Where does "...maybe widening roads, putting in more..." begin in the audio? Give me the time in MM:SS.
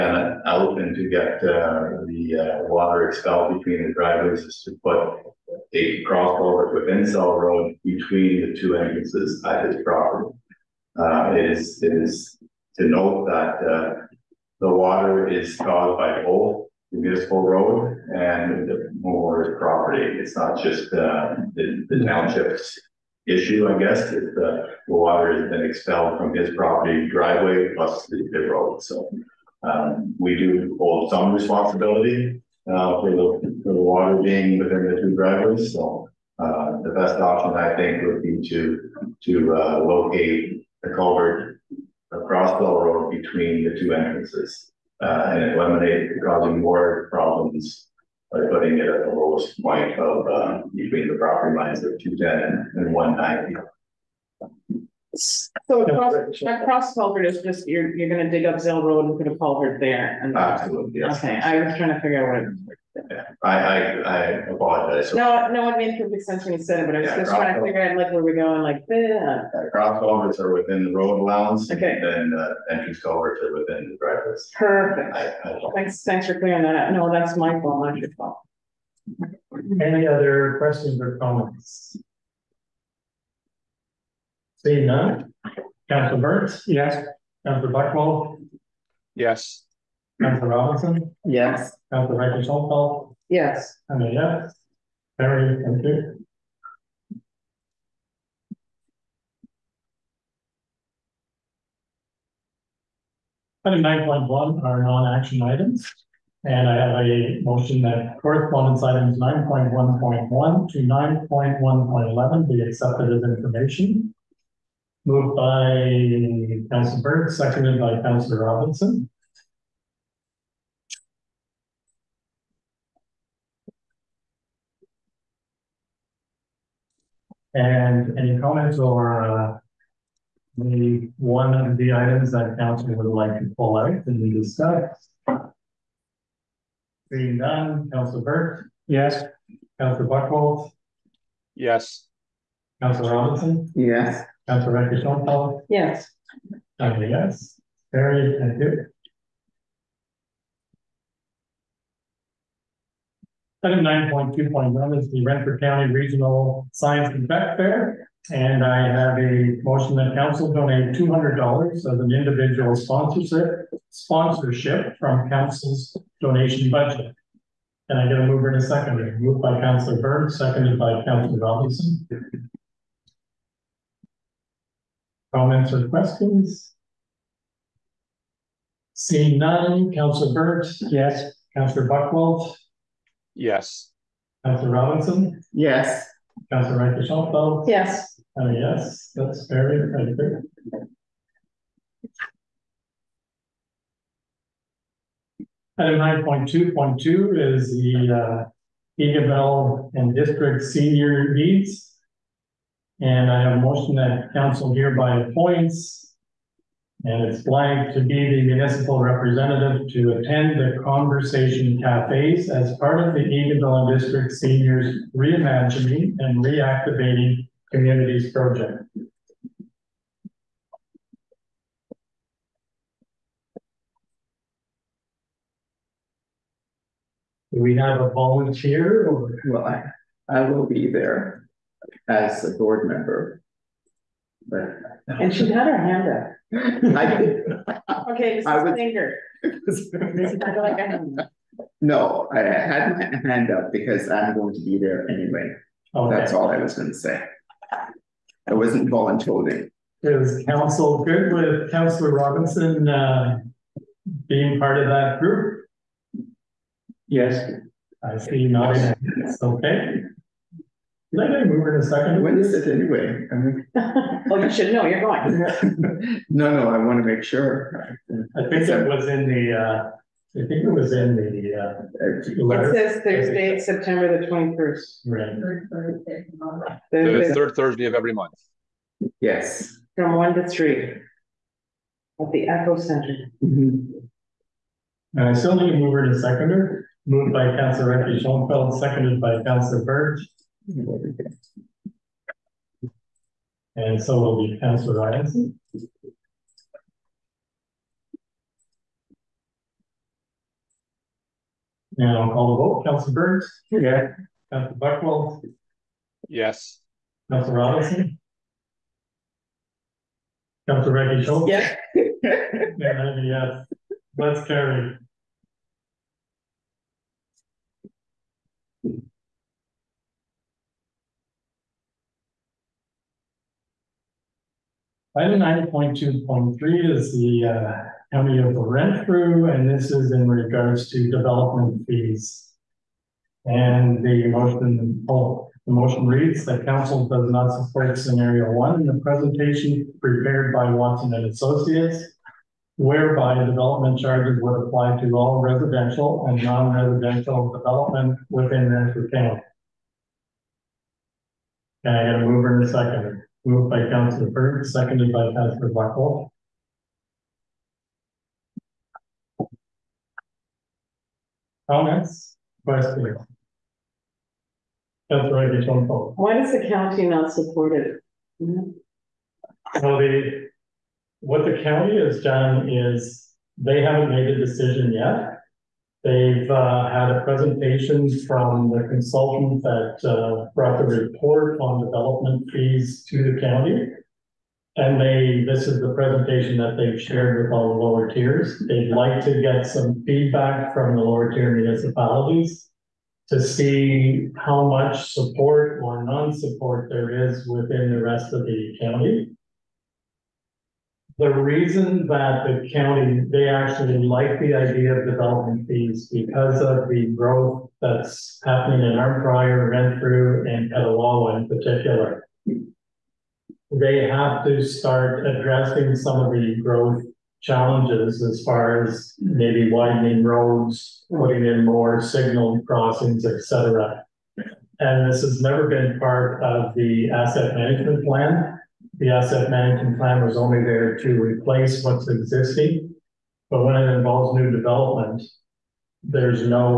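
06:59.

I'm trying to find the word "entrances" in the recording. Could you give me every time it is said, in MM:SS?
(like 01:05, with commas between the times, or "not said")
00:08, 00:43, 01:12.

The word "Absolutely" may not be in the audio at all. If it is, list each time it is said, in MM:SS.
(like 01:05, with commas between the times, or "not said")
01:00.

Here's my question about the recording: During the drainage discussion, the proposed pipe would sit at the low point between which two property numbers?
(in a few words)
210 and 190.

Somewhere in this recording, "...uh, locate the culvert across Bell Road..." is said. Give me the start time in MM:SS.
00:39.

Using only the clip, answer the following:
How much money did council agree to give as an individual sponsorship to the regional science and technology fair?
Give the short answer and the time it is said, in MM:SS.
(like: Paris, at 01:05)
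$200, at 02:40.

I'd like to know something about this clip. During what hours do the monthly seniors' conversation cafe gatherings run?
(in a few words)
1 to 3.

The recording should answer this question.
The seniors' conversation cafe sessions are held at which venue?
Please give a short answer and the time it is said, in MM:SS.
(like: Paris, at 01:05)
Echo Center, at 04:42.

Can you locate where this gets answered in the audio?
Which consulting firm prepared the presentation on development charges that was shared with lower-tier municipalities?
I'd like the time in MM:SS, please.
05:40.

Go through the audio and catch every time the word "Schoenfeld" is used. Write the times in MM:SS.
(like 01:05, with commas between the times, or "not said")
02:25, 03:07, 04:48.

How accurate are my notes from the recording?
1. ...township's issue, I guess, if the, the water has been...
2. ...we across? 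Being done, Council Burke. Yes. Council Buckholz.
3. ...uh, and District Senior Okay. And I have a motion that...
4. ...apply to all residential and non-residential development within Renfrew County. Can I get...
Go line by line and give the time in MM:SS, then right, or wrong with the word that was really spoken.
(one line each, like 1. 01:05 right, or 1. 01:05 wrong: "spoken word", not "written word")
1. 00:22 right
2. 02:14 wrong: "discuss", not "across"
3. 03:18 wrong: "Needs", not "Okay"
4. 05:44 right.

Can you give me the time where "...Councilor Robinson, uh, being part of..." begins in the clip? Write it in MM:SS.
04:11.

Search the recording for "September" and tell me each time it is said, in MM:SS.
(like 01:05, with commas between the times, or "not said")
04:33.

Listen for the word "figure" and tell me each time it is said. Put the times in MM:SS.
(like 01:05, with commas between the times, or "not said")
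01:02, 01:07.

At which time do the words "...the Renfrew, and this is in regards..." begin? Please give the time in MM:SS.
05:28.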